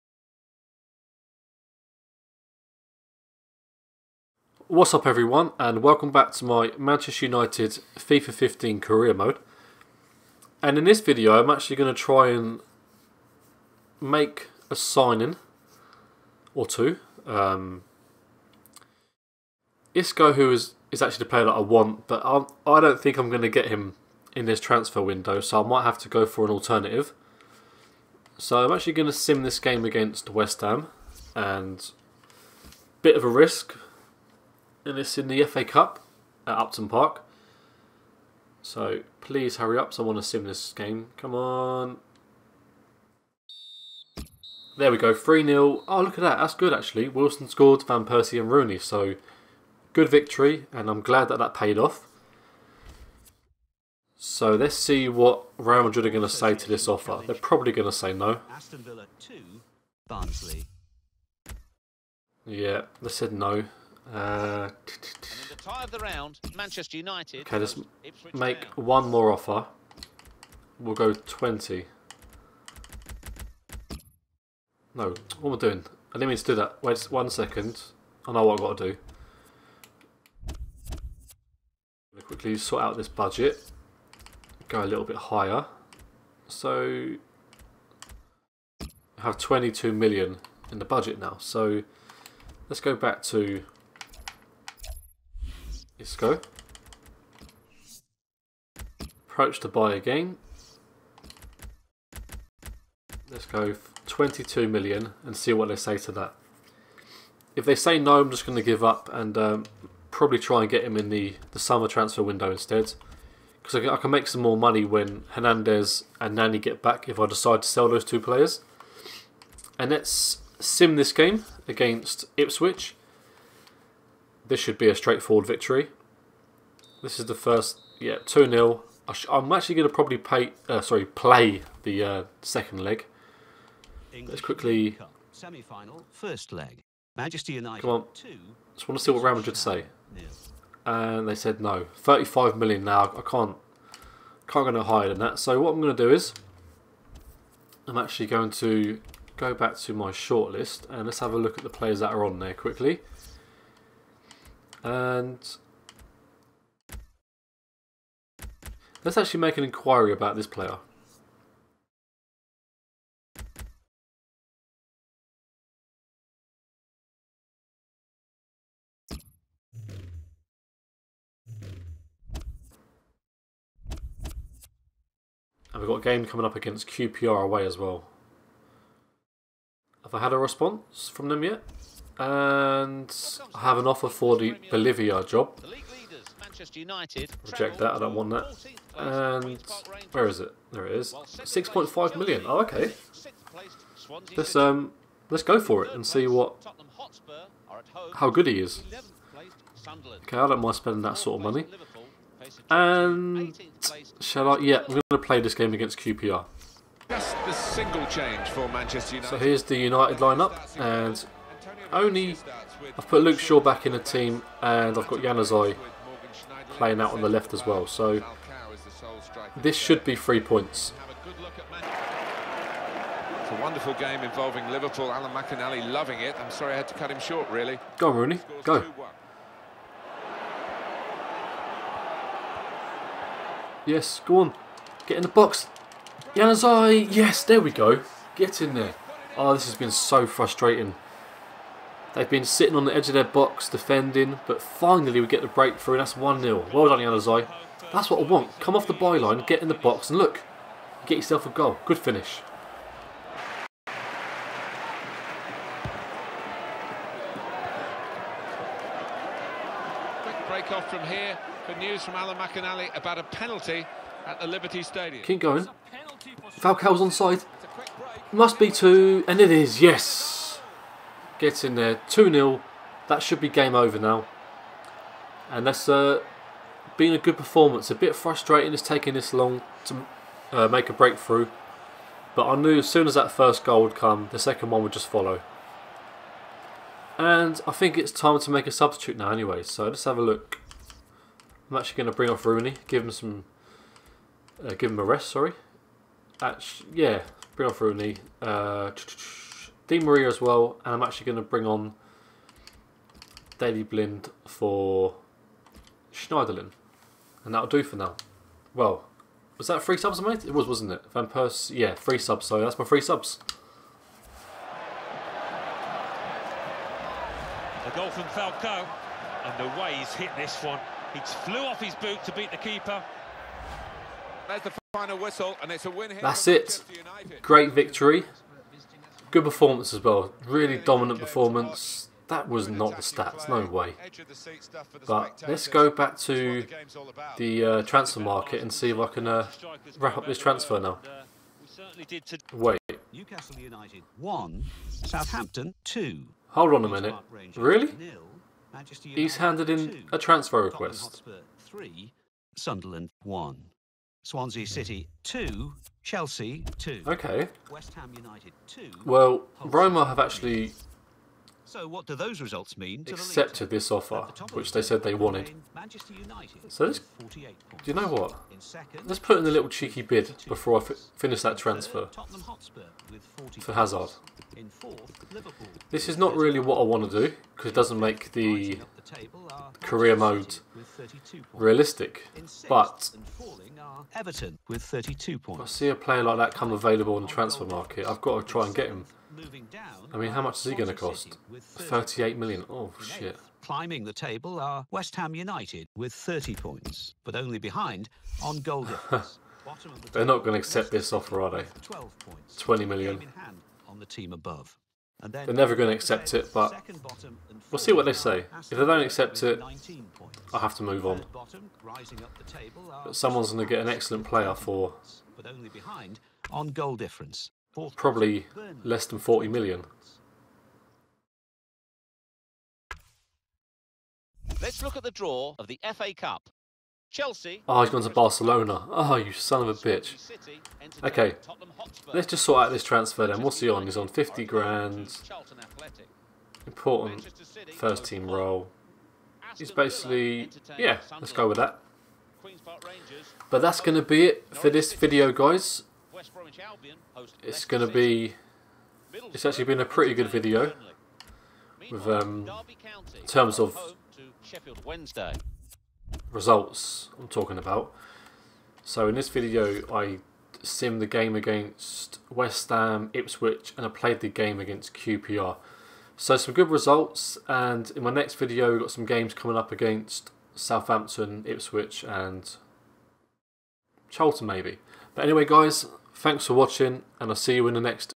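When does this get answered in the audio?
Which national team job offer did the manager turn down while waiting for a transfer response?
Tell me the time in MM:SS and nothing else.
03:04.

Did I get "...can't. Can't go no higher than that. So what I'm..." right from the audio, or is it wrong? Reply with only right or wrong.
right.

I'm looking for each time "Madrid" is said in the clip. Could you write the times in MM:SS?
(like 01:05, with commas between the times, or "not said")
00:55, 02:19.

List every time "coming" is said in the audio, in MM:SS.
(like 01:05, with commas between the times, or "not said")
02:56, 07:49.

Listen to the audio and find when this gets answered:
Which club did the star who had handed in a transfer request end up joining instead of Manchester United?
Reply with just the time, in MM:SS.
07:08.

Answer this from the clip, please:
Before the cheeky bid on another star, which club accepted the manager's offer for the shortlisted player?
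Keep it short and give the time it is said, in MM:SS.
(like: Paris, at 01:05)
Roma, at 05:59.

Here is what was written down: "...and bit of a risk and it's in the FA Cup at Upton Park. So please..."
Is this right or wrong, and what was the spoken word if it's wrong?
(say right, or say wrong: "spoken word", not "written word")
right.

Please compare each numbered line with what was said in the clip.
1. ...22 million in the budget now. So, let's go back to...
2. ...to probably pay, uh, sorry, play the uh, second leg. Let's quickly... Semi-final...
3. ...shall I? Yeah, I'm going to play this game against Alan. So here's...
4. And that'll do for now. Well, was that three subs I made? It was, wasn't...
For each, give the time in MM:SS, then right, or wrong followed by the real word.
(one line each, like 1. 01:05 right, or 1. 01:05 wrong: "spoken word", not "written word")
1. 01:29 right
2. 02:09 right
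3. 03:24 wrong: "QPR", not "Alan"
4. 05:07 right.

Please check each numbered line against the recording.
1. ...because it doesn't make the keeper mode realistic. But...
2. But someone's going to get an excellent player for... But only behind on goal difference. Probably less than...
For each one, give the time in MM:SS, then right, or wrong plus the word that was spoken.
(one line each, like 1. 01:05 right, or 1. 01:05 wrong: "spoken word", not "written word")
1. 06:17 wrong: "career", not "keeper"
2. 06:53 right.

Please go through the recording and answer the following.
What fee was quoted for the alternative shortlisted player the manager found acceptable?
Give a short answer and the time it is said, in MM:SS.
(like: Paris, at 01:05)
6.5 million, at 03:11.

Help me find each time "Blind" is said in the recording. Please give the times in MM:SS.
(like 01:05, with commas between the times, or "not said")
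05:03.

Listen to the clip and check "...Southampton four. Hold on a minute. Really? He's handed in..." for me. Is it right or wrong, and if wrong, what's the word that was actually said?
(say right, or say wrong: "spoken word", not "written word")
wrong: "two", not "four".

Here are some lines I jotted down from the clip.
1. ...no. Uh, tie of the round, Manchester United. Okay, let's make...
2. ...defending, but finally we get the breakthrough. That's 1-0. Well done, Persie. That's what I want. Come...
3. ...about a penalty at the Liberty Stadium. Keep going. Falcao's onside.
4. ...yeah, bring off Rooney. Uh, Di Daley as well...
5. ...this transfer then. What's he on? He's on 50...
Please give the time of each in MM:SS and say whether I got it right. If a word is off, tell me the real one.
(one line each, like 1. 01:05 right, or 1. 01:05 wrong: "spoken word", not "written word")
1. 01:03 right
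2. 04:03 wrong: "Januzaj", not "Persie"
3. 04:22 right
4. 04:56 wrong: "Maria", not "Daley"
5. 07:12 right.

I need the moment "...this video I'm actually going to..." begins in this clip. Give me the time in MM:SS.
00:10.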